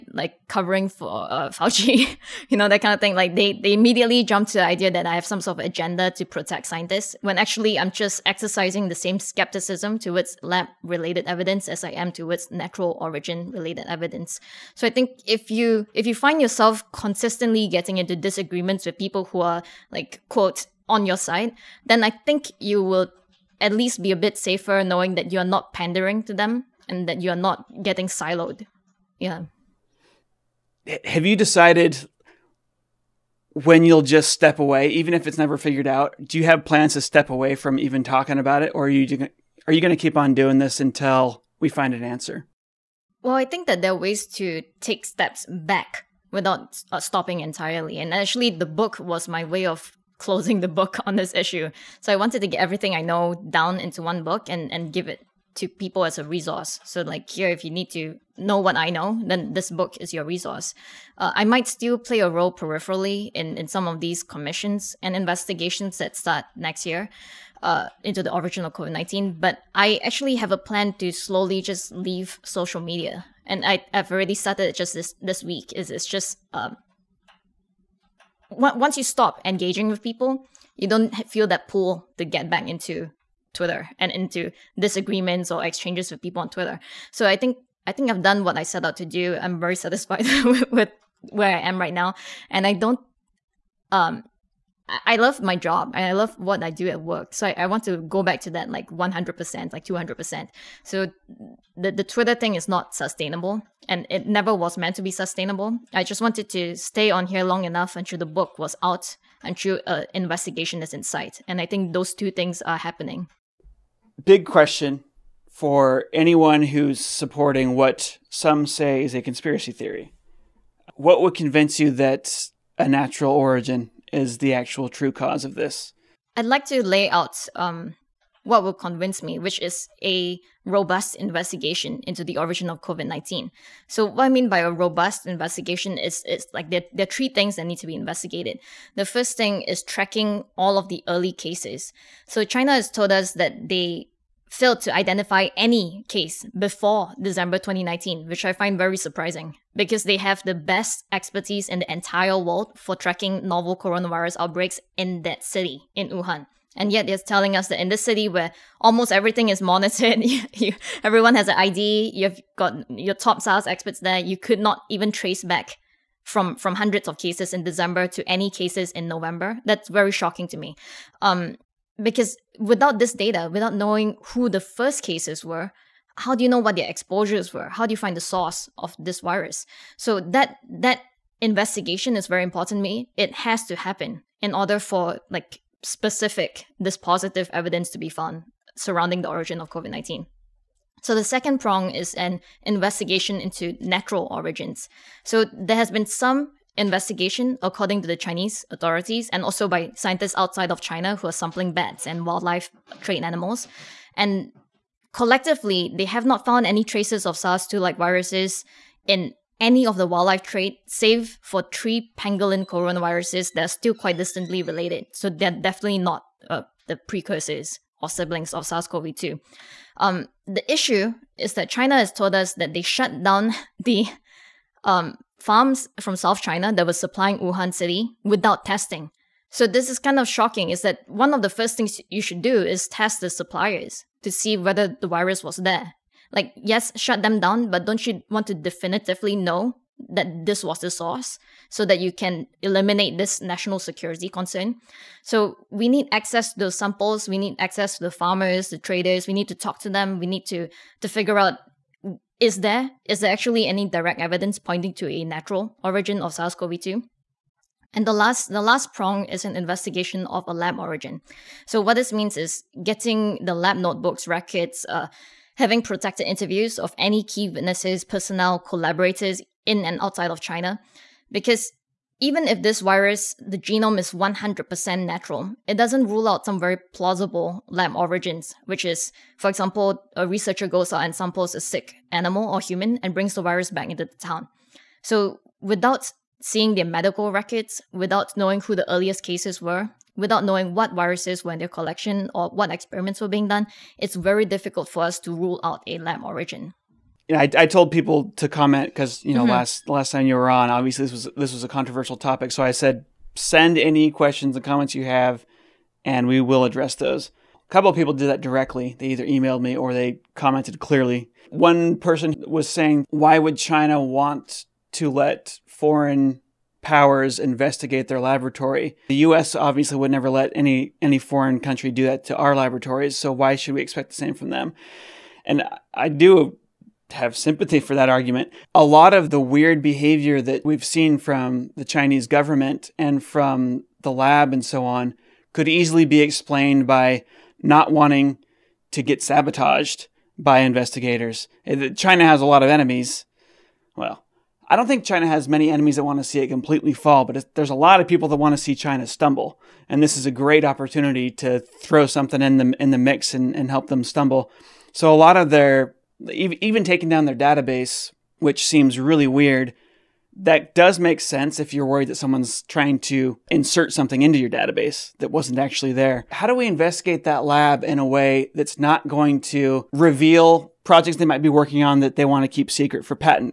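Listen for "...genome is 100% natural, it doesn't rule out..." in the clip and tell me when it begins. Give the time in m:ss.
4:33.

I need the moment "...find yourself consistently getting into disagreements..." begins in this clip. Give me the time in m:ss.
0:16.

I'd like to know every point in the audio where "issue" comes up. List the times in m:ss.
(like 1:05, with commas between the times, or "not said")
0:51, 3:40.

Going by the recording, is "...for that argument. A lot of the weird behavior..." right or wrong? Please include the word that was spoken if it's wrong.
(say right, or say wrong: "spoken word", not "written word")
right.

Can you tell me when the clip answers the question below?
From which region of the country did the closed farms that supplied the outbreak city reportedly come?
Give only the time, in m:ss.
3:46.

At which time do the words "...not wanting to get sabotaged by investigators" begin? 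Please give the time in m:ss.
5:37.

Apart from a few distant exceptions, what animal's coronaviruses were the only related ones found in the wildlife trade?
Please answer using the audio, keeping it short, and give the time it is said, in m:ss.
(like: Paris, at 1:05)
pangolin, at 3:32.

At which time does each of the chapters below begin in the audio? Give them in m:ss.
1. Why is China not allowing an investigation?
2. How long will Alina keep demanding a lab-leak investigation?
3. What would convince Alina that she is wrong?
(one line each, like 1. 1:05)
1. 4:53
2. 0:30
3. 1:52.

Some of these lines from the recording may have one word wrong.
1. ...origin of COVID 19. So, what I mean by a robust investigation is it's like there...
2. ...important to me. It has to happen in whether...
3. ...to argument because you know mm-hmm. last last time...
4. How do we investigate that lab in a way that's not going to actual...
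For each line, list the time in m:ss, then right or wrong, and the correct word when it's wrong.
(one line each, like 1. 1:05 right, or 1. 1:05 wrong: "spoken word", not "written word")
1. 2:12 right
2. 3:02 wrong: "order", not "whether"
3. 4:58 wrong: "comment", not "argument"
4. 6:06 wrong: "reveal", not "actual".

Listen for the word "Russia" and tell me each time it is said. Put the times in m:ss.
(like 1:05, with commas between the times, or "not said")
not said.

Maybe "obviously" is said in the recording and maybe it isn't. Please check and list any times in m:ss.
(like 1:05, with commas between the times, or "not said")
5:00, 5:19.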